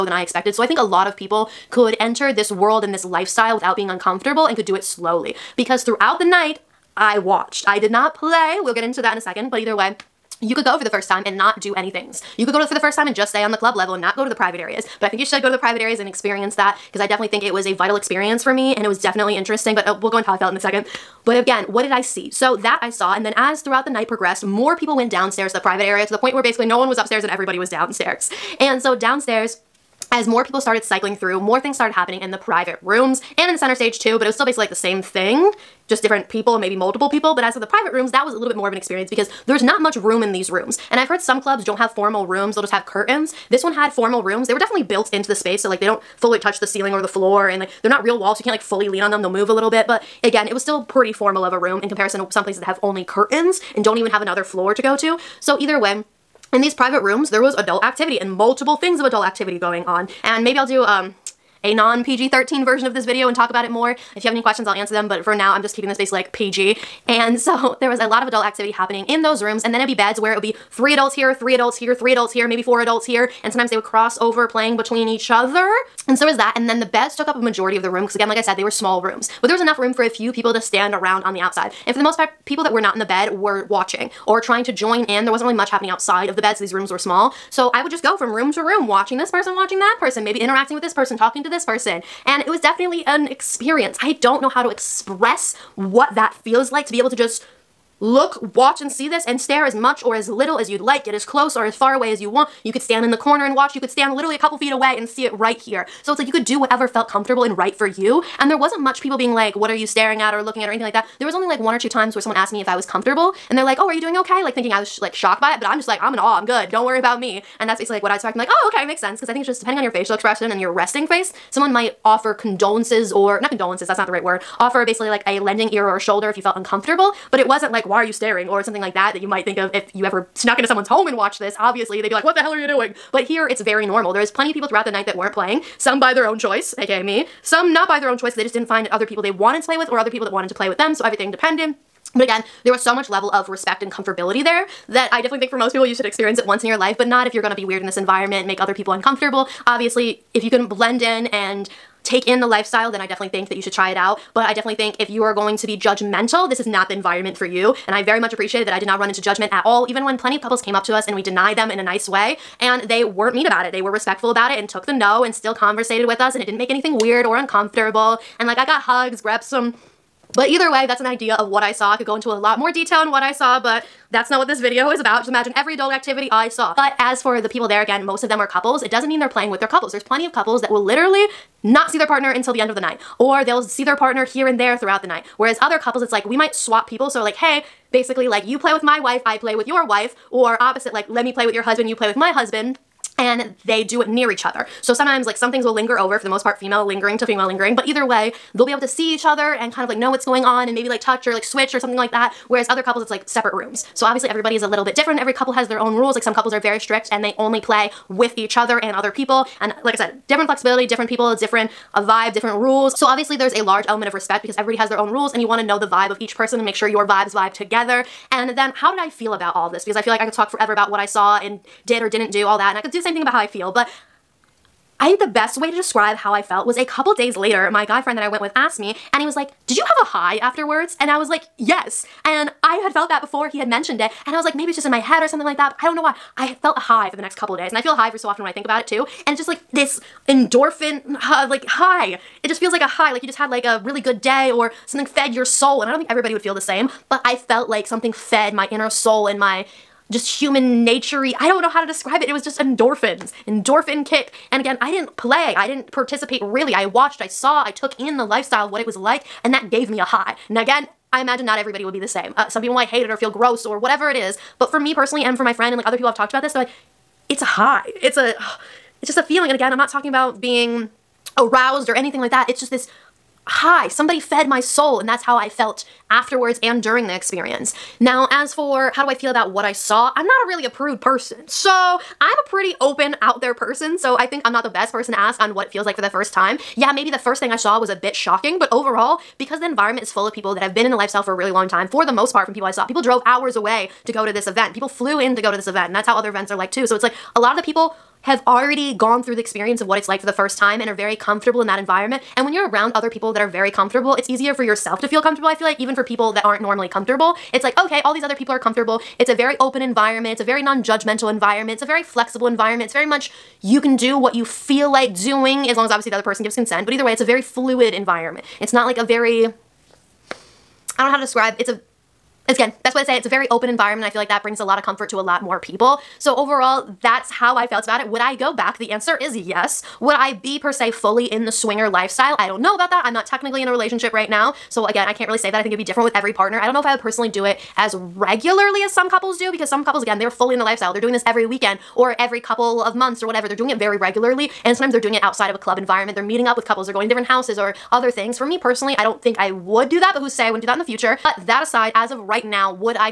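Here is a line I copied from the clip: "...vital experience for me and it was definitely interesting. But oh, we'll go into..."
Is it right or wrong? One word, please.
right.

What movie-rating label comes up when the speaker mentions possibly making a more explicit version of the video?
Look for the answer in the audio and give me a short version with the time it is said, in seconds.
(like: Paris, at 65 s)
PG-13, at 62 s.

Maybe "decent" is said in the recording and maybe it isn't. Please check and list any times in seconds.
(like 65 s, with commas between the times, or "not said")
not said.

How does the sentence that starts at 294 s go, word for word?
People flew in to go to this event and that's how other events are like too.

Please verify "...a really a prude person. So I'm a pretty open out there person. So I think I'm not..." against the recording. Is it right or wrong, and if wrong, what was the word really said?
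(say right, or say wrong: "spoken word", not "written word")
right.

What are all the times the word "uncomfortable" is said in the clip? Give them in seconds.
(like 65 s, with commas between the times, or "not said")
3 s, 126 s, 148 s, 167 s.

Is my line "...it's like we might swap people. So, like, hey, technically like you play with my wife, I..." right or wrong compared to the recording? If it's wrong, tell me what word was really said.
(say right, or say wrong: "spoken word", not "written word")
wrong: "basically", not "technically".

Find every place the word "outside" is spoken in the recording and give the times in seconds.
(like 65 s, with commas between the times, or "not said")
81 s, 85 s, 345 s.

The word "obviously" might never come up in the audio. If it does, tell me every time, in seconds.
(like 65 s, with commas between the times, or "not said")
131 s, 149 s, 204 s, 213 s, 315 s.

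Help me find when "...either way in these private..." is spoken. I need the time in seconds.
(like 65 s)
55 s.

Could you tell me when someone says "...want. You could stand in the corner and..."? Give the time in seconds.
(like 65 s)
102 s.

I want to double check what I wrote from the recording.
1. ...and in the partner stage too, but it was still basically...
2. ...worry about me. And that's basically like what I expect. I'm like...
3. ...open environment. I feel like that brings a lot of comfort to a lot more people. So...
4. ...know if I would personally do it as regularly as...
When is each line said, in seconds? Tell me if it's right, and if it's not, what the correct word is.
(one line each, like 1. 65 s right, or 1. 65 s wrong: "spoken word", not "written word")
1. 33 s wrong: "center", not "partner"
2. 116 s right
3. 323 s right
4. 336 s right.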